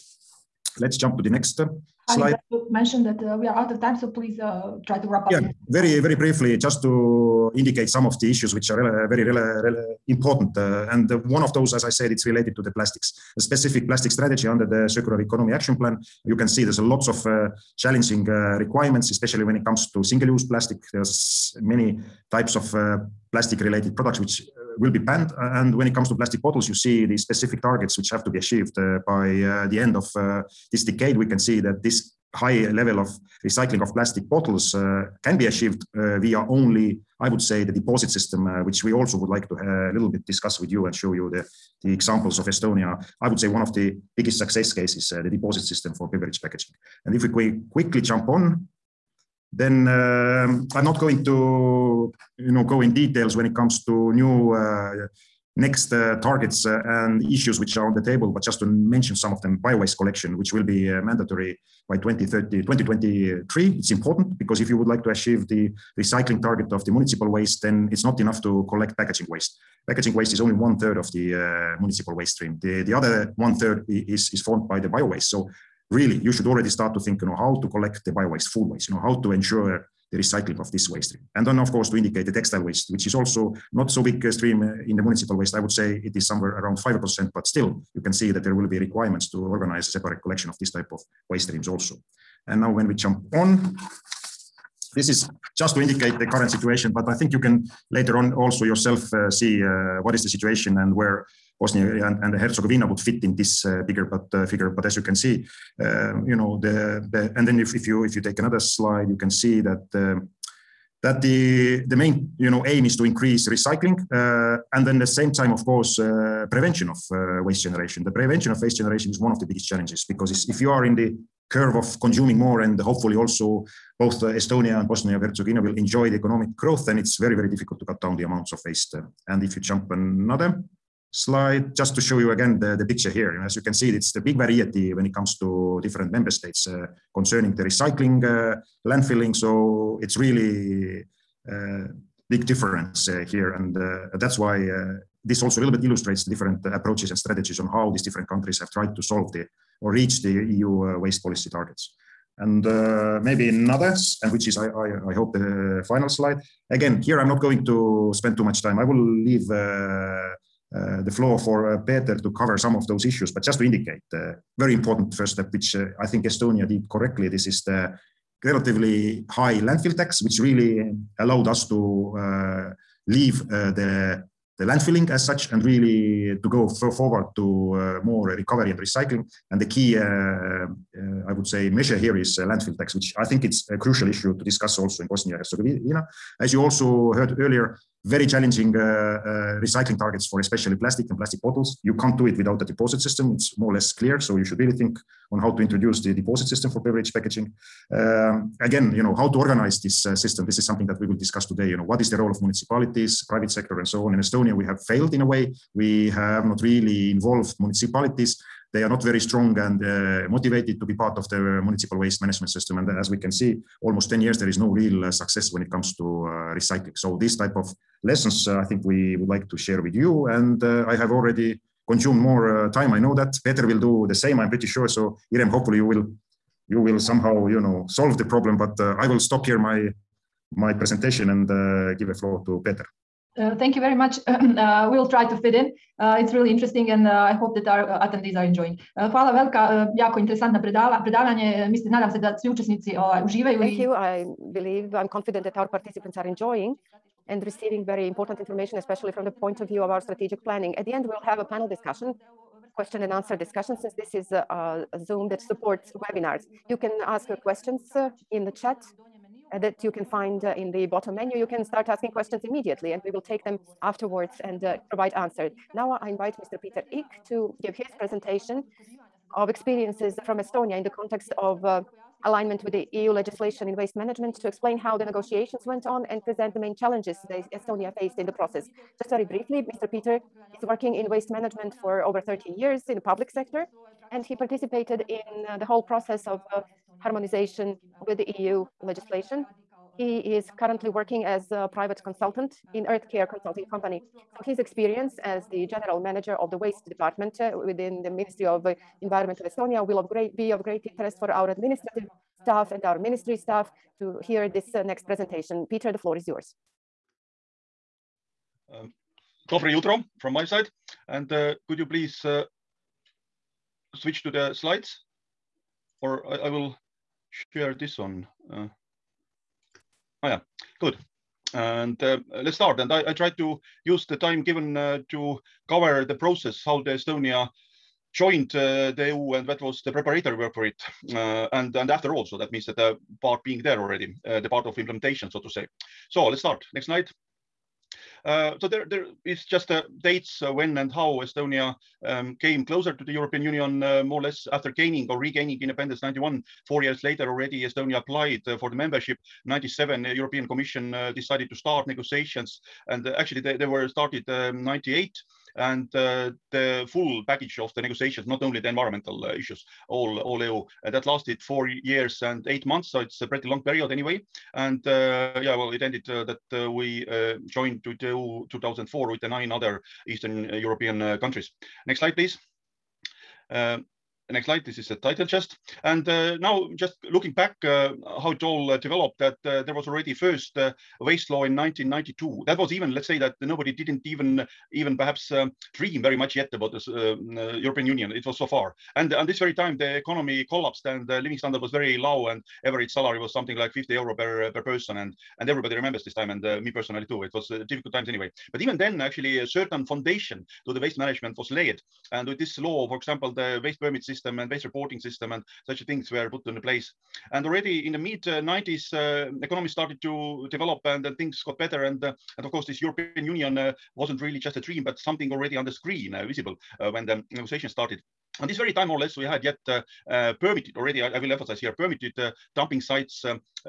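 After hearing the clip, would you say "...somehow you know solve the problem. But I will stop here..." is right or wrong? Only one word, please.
right.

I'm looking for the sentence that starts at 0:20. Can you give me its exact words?
There's many types of uh, plastic-related products which uh, will be banned.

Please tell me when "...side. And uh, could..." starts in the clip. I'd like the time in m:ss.
5:10.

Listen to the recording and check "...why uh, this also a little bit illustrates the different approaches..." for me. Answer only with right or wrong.
right.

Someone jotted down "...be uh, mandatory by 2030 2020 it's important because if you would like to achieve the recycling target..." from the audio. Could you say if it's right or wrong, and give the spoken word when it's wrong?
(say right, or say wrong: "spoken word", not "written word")
wrong: "2023", not "2020".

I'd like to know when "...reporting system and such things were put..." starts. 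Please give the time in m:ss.
6:44.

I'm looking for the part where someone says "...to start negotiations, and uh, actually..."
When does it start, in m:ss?
5:51.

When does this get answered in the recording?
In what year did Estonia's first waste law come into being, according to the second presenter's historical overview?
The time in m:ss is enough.
6:21.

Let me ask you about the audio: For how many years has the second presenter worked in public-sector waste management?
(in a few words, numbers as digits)
30 years.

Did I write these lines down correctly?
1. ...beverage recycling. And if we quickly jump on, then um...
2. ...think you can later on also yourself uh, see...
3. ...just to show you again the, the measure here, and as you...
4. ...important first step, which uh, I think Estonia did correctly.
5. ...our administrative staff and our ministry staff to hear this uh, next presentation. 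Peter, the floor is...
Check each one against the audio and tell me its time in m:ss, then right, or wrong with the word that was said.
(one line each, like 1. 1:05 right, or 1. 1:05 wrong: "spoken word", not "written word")
1. 0:46 wrong: "packaging", not "recycling"
2. 1:37 right
3. 2:11 wrong: "picture", not "measure"
4. 2:44 right
5. 5:01 right.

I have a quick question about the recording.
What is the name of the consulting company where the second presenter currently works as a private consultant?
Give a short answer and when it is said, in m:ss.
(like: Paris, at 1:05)
Earth Care Consulting, at 4:52.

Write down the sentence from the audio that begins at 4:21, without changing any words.
You can start asking questions immediately and we will take them afterwards and uh, provide answers.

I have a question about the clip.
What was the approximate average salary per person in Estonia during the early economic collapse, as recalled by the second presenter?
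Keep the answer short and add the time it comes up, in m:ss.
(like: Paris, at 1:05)
50 euro, at 6:33.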